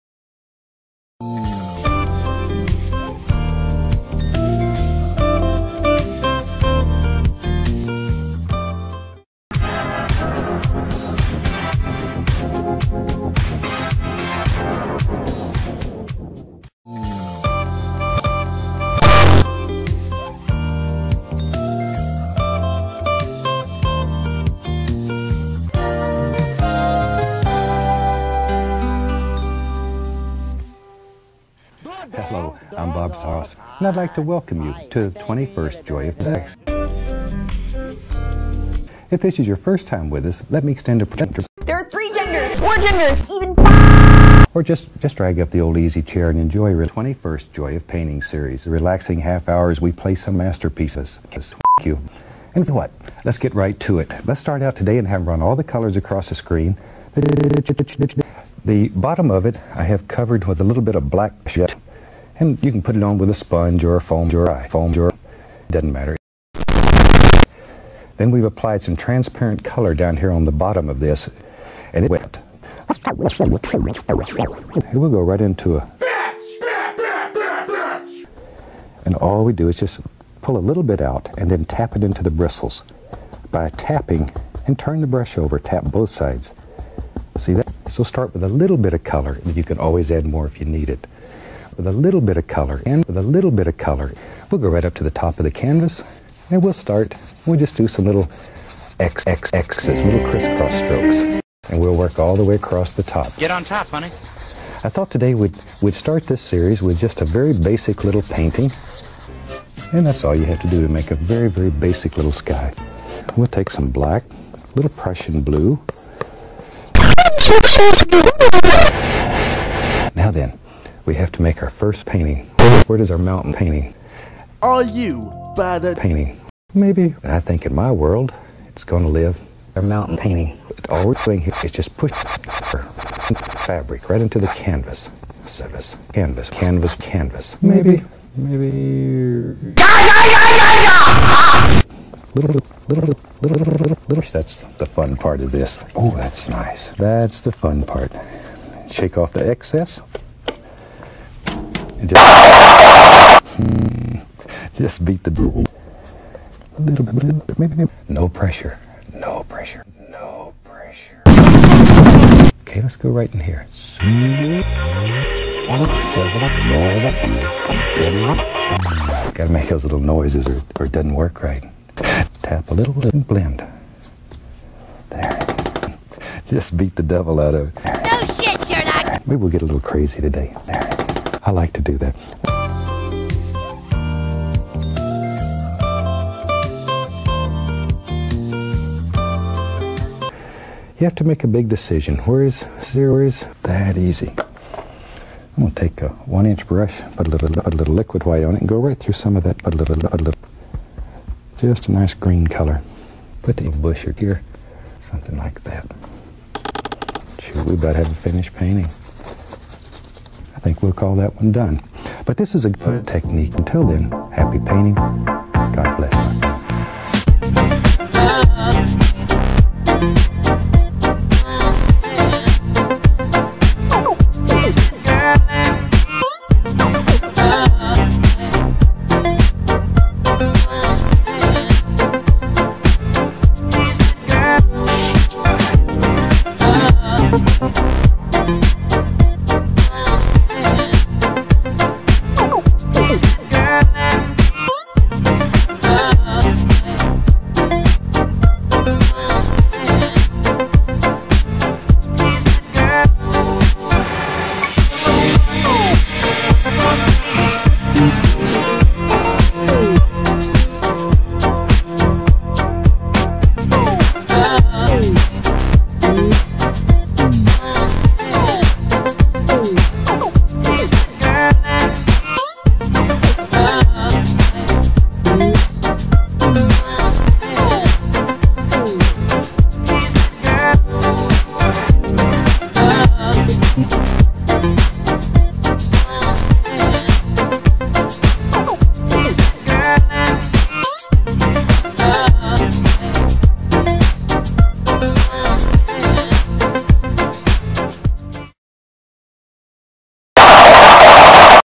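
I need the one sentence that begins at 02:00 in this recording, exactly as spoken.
Now then, we have to make our first painting.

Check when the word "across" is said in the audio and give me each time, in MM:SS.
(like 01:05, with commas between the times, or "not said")
00:55, 01:42.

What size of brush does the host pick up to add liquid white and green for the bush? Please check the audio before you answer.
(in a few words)
one inch.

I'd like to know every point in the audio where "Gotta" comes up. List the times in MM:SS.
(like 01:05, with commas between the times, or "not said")
02:49.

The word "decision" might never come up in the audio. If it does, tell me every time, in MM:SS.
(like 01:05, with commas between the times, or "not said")
03:11.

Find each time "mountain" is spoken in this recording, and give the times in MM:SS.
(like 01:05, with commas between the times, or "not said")
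02:03, 02:09.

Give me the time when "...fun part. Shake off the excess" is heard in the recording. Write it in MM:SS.
02:27.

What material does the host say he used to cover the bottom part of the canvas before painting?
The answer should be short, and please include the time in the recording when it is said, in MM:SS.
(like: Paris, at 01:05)
black gesso, at 01:01.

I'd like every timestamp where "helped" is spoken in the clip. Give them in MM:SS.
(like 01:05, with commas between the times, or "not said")
not said.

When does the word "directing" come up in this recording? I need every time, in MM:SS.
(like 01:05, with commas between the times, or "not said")
not said.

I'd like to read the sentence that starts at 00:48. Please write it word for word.
The relaxing half hours we play some masterpieces.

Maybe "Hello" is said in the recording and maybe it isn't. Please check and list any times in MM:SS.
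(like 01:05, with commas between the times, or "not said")
00:32.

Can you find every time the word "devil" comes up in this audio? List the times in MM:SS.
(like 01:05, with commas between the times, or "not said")
02:35, 02:57.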